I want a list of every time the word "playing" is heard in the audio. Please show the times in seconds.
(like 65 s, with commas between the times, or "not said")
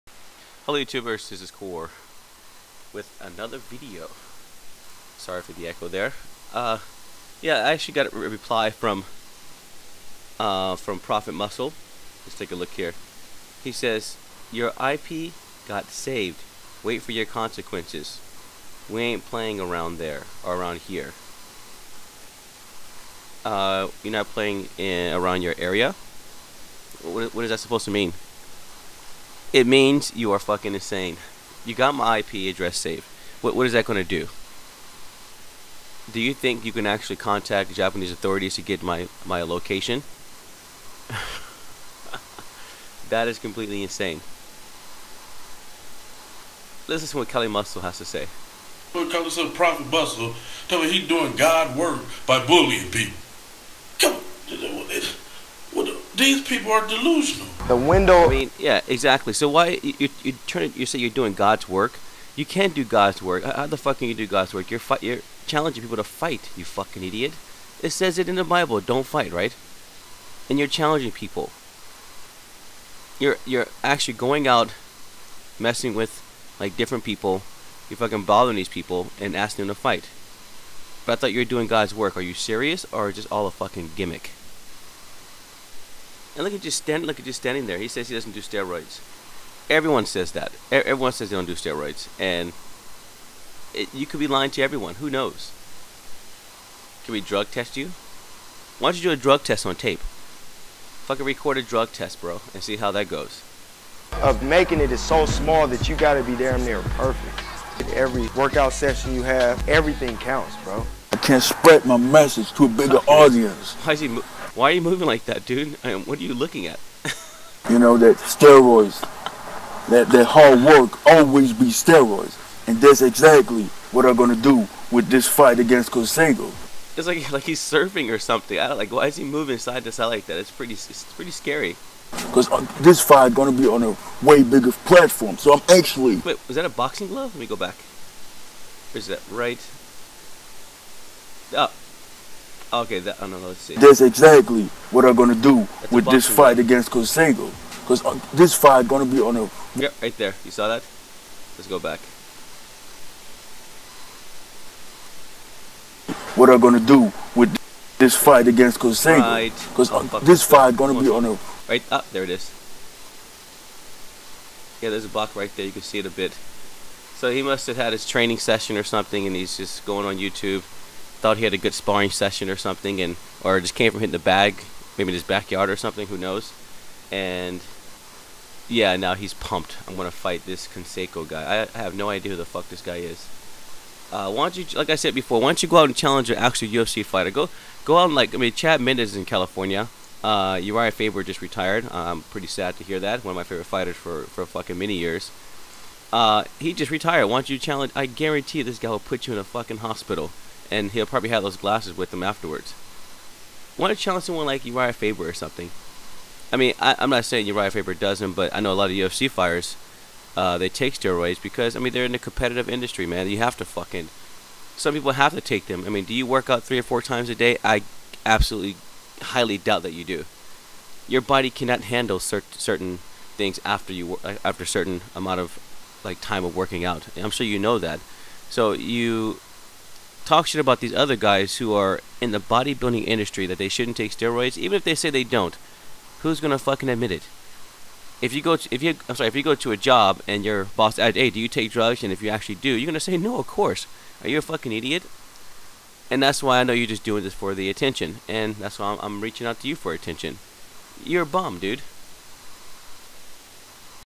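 19 s, 24 s.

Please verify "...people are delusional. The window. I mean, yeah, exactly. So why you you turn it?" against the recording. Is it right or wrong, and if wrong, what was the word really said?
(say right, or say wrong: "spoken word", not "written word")
right.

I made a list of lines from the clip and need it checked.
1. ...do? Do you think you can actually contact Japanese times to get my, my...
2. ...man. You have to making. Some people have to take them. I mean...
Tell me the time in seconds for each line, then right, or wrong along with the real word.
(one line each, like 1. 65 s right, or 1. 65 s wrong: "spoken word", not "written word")
1. 34 s wrong: "authorities", not "times"
2. 213 s wrong: "fucking", not "making".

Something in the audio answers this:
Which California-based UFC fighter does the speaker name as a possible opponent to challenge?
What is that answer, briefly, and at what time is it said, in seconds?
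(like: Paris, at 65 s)
Chad Mendes, at 188 s.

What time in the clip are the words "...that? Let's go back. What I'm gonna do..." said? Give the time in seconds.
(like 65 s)
150 s.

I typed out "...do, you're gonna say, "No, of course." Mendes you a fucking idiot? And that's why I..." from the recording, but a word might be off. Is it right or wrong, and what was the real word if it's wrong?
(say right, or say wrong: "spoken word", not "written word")
wrong: "Are", not "Mendes".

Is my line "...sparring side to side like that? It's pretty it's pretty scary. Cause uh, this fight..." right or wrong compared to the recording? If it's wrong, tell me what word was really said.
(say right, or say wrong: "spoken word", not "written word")
wrong: "moving", not "sparring".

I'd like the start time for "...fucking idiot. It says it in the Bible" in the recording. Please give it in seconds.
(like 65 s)
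66 s.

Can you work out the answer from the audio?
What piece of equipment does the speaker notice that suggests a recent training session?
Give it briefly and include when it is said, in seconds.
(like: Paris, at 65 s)
Boxing glove, at 136 s.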